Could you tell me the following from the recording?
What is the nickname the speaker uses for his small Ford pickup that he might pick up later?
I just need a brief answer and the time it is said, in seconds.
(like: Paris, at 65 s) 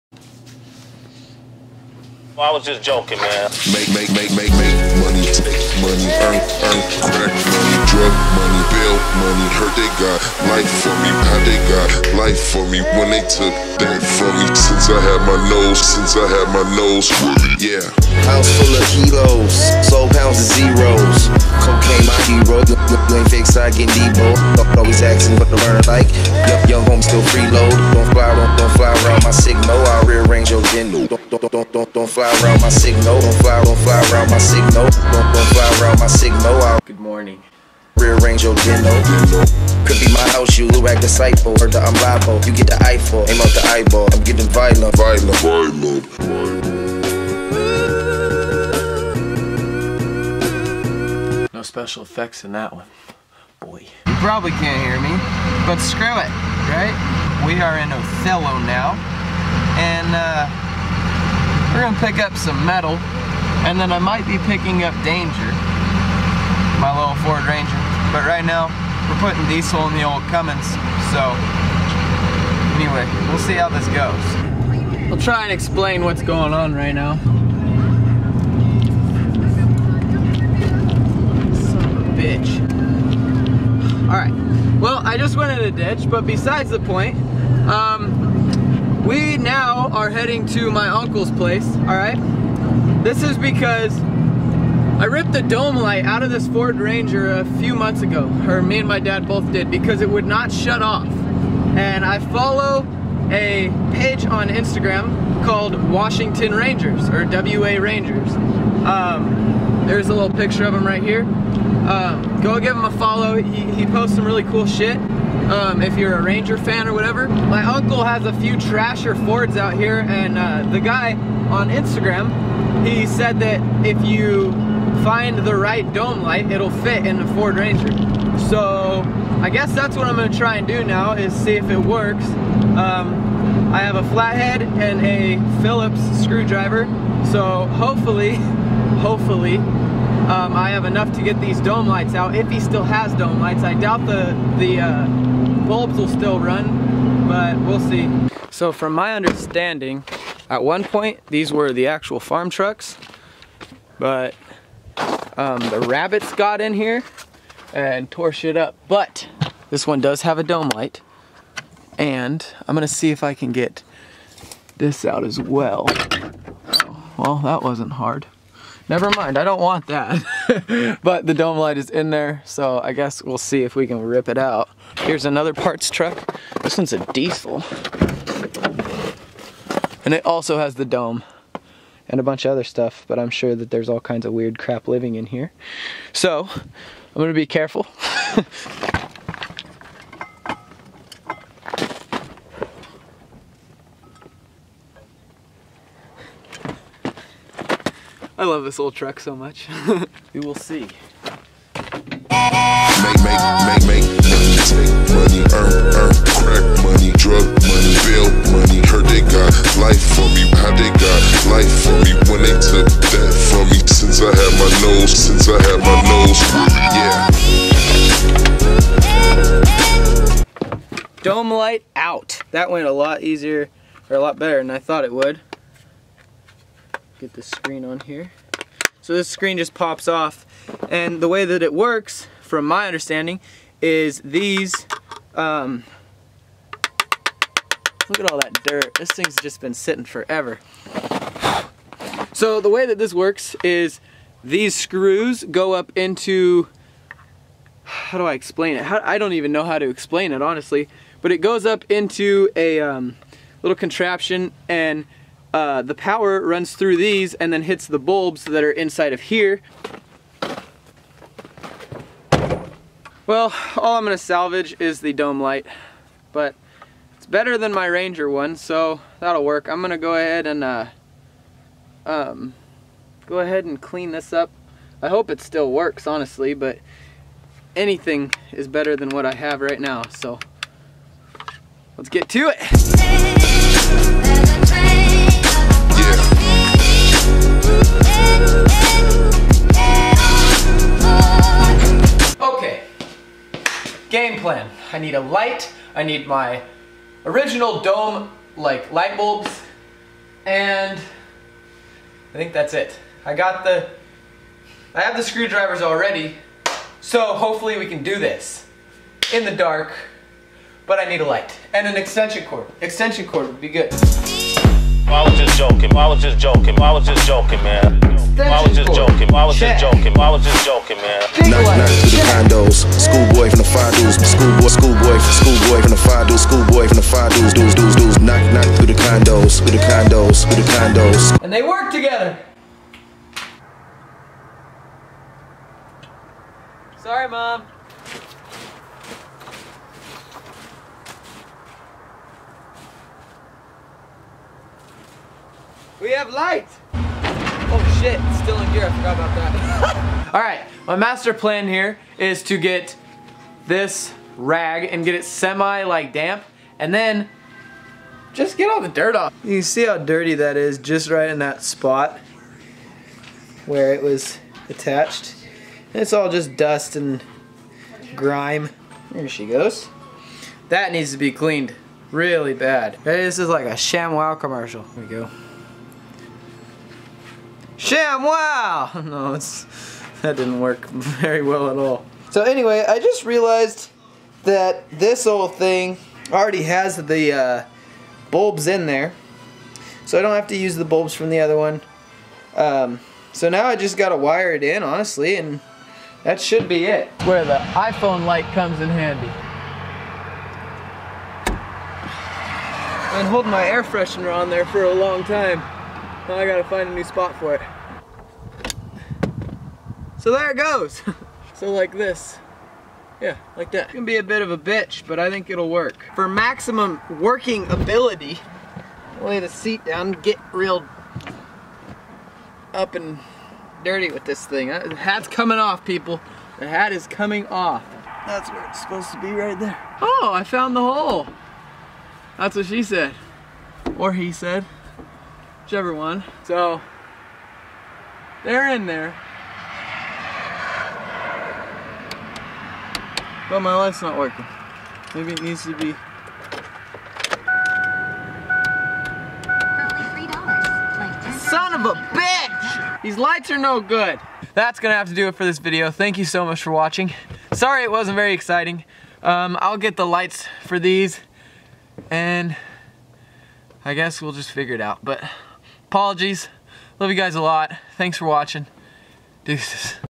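Danger, at 65 s.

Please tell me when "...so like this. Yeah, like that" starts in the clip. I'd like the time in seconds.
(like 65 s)
411 s.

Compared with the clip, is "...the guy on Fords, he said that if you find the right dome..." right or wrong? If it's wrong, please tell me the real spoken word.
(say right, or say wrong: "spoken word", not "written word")
wrong: "Instagram", not "Fords".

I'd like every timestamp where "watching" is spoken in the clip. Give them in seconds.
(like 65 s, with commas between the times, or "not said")
456 s, 468 s.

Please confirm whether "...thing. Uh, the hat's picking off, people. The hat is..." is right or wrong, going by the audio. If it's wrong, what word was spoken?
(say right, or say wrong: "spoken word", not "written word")
wrong: "coming", not "picking".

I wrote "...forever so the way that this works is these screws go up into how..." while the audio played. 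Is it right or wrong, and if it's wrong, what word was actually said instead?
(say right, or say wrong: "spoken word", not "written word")
right.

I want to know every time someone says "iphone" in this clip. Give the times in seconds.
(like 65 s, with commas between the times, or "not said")
397 s.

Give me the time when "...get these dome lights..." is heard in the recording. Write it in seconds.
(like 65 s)
141 s.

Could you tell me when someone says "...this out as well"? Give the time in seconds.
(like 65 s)
164 s.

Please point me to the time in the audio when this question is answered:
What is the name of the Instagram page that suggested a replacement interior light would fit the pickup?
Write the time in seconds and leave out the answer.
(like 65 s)
105 s.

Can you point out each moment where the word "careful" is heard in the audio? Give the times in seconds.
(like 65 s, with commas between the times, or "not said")
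187 s.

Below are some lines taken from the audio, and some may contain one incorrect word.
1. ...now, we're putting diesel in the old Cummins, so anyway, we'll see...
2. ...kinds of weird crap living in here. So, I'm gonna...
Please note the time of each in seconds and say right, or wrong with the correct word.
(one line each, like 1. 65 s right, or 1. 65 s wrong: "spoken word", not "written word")
1. 68 s right
2. 184 s right.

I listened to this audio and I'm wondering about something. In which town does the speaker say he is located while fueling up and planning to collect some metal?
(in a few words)
Othello.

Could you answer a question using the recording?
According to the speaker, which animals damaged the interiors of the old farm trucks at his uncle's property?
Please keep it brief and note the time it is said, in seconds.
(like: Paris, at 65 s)
rabbits, at 155 s.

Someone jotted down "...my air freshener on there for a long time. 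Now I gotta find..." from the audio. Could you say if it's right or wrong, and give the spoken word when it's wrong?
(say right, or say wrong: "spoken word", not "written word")
right.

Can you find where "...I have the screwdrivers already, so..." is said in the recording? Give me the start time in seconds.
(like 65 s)
304 s.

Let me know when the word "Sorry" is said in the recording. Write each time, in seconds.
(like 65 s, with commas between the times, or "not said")
336 s, 457 s.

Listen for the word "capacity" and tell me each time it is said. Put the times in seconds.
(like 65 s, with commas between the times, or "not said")
not said.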